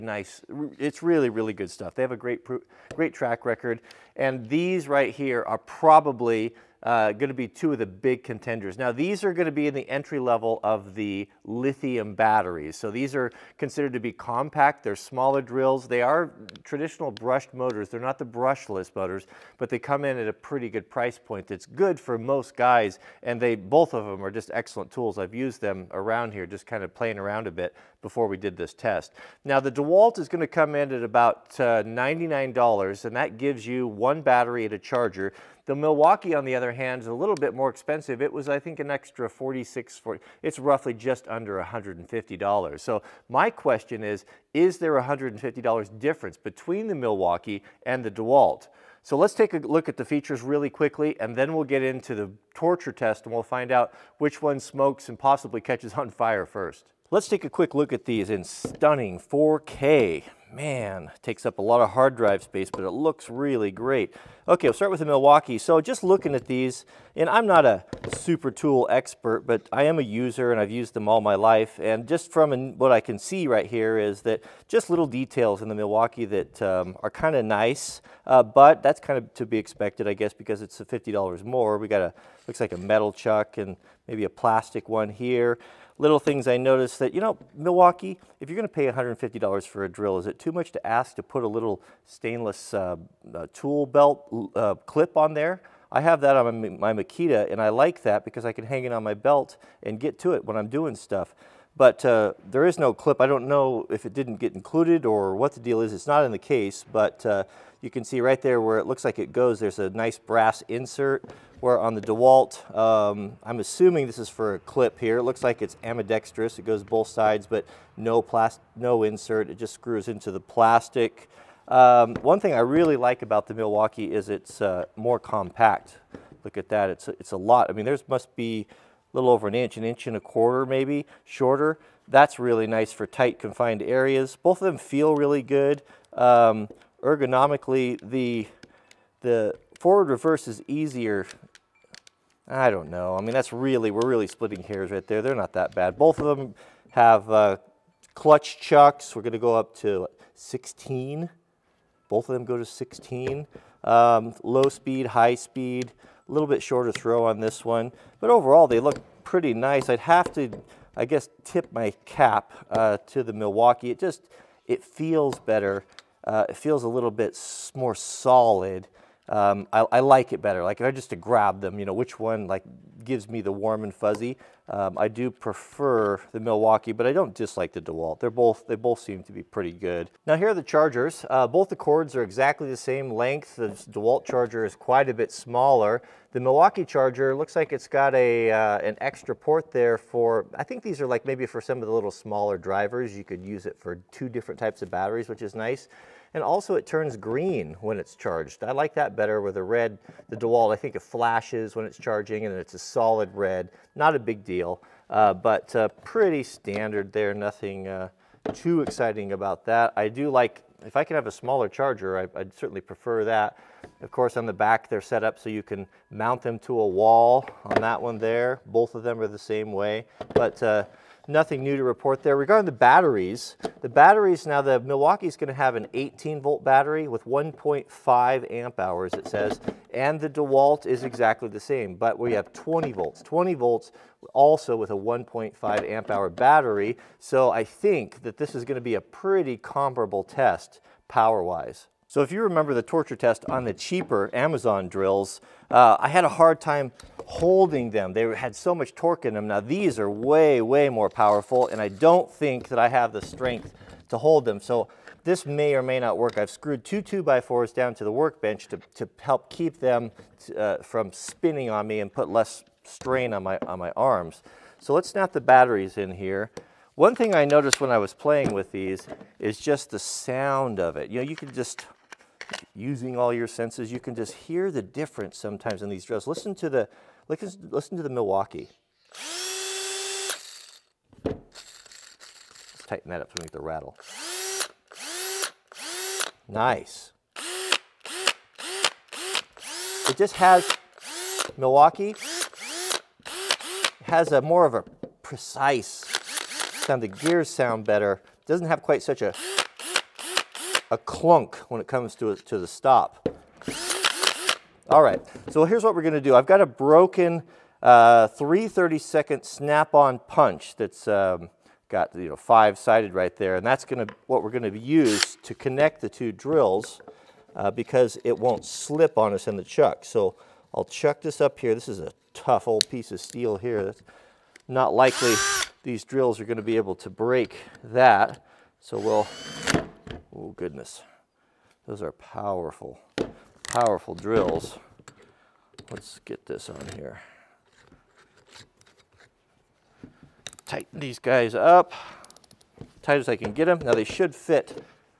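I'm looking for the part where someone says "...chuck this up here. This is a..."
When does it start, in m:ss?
5:20.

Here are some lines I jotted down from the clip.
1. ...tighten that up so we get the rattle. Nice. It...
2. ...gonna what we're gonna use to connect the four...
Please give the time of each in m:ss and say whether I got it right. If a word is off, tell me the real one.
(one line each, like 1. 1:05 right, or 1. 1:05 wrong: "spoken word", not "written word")
1. 4:42 right
2. 5:13 wrong: "two", not "four".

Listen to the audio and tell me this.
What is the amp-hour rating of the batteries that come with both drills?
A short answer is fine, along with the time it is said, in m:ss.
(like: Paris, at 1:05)
1.5 amp hours, at 3:47.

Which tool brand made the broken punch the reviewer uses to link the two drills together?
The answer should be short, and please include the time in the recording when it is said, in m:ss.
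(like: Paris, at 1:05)
Snap-on, at 5:09.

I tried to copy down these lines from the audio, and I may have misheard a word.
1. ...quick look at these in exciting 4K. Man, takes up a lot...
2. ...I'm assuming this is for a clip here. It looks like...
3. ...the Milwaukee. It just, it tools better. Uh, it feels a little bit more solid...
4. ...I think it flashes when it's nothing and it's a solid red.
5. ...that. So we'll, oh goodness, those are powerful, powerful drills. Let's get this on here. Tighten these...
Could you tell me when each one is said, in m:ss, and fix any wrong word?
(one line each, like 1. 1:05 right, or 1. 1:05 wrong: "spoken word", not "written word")
1. 0:57 wrong: "stunning", not "exciting"
2. 1:53 right
3. 2:43 wrong: "feels", not "tools"
4. 3:20 wrong: "charging", not "nothing"
5. 5:27 right.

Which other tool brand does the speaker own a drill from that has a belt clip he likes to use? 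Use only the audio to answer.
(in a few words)
Makita.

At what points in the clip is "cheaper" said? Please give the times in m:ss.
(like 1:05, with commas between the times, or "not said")
4:03.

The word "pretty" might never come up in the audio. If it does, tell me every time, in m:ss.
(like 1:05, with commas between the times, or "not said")
0:20, 2:39, 2:59, 3:26, 3:59.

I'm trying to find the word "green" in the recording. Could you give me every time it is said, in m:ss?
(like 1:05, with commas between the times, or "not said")
3:17.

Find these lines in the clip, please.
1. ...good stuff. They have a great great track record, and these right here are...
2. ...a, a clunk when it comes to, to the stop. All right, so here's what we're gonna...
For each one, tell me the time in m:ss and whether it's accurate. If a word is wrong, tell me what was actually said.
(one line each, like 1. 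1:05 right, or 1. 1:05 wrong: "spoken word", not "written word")
1. 0:01 right
2. 4:59 right.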